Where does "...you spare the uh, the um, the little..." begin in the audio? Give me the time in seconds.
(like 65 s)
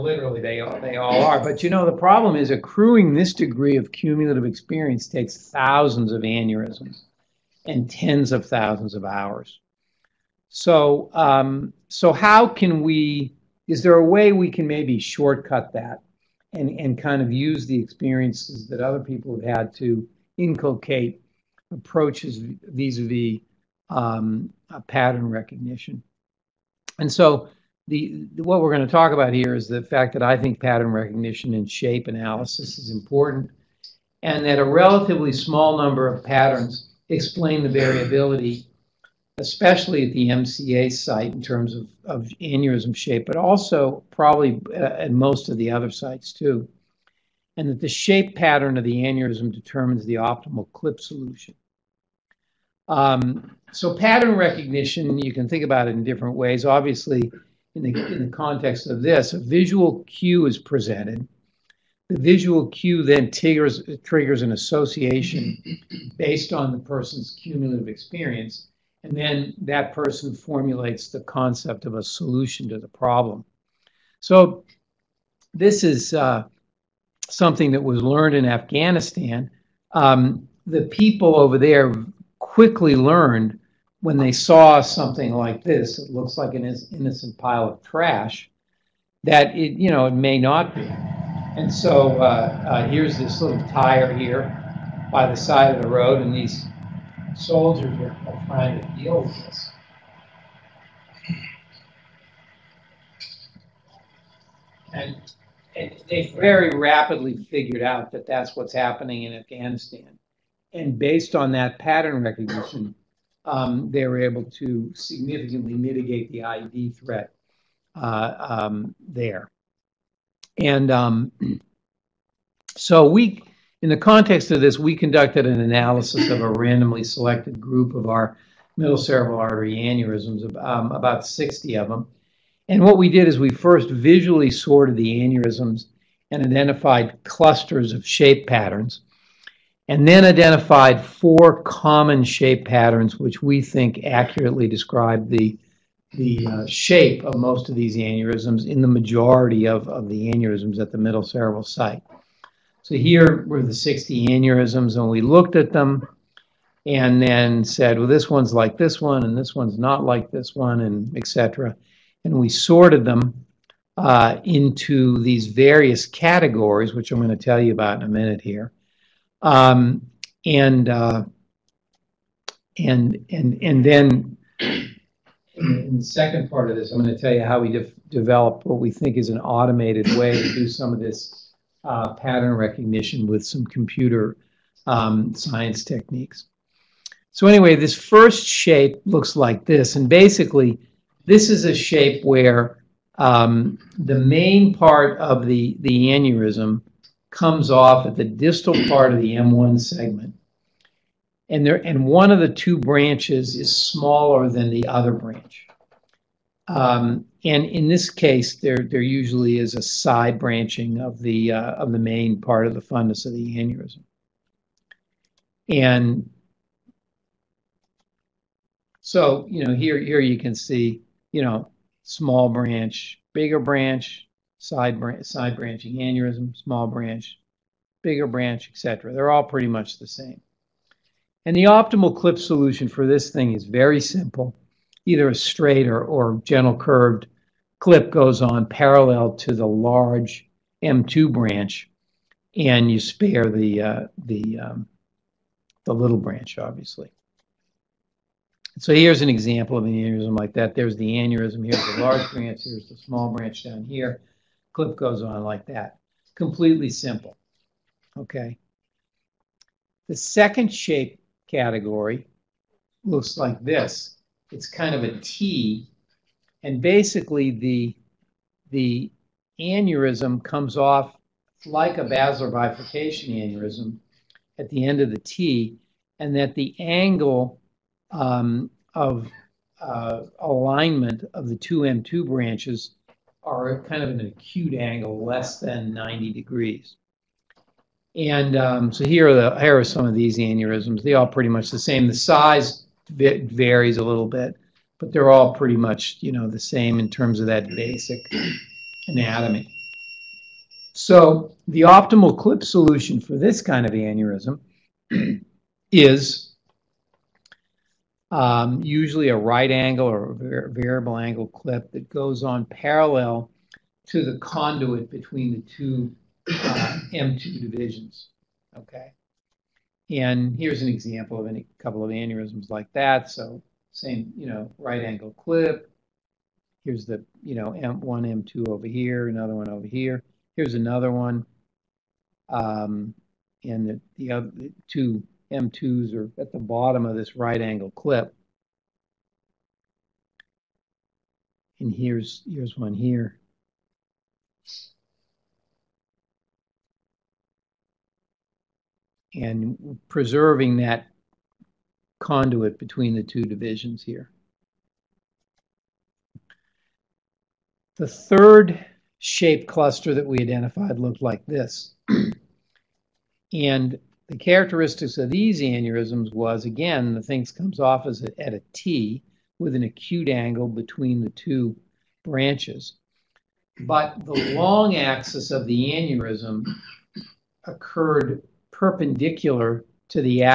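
242 s.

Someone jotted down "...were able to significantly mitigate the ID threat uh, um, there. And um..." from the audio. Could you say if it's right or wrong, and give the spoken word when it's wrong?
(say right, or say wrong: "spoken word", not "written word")
right.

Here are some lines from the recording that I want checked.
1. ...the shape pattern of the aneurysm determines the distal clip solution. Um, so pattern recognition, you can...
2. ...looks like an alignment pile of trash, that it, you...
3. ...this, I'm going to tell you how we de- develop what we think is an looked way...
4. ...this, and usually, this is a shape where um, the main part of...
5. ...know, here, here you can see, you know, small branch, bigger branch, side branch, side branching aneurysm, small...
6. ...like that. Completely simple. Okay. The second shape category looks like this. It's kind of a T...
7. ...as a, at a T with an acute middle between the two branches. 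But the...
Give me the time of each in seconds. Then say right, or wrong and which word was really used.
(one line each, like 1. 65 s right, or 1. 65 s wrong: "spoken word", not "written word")
1. 47 s wrong: "optimal", not "distal"
2. 86 s wrong: "innocent", not "alignment"
3. 176 s wrong: "automated", not "looked"
4. 189 s wrong: "basically", not "usually"
5. 219 s right
6. 255 s right
7. 368 s wrong: "angle", not "middle".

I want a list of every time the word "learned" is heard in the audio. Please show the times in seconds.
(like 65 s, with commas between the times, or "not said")
78 s, 82 s.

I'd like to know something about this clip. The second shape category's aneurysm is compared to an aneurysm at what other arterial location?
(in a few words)
basilar bifurcation.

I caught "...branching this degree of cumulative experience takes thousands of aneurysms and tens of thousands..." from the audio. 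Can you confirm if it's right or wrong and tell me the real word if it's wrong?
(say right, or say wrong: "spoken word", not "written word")
wrong: "accruing", not "branching".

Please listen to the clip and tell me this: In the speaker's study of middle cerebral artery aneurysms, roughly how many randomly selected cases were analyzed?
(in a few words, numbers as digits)
60.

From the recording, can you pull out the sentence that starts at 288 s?
And um, so here are, the, here are some of these aneurysms.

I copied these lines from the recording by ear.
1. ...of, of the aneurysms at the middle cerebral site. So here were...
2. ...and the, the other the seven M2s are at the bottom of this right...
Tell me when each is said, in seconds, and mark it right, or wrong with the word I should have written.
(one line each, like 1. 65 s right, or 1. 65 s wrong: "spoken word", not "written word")
1. 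149 s right
2. 333 s wrong: "two", not "seven".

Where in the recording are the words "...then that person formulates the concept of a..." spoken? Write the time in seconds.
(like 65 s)
69 s.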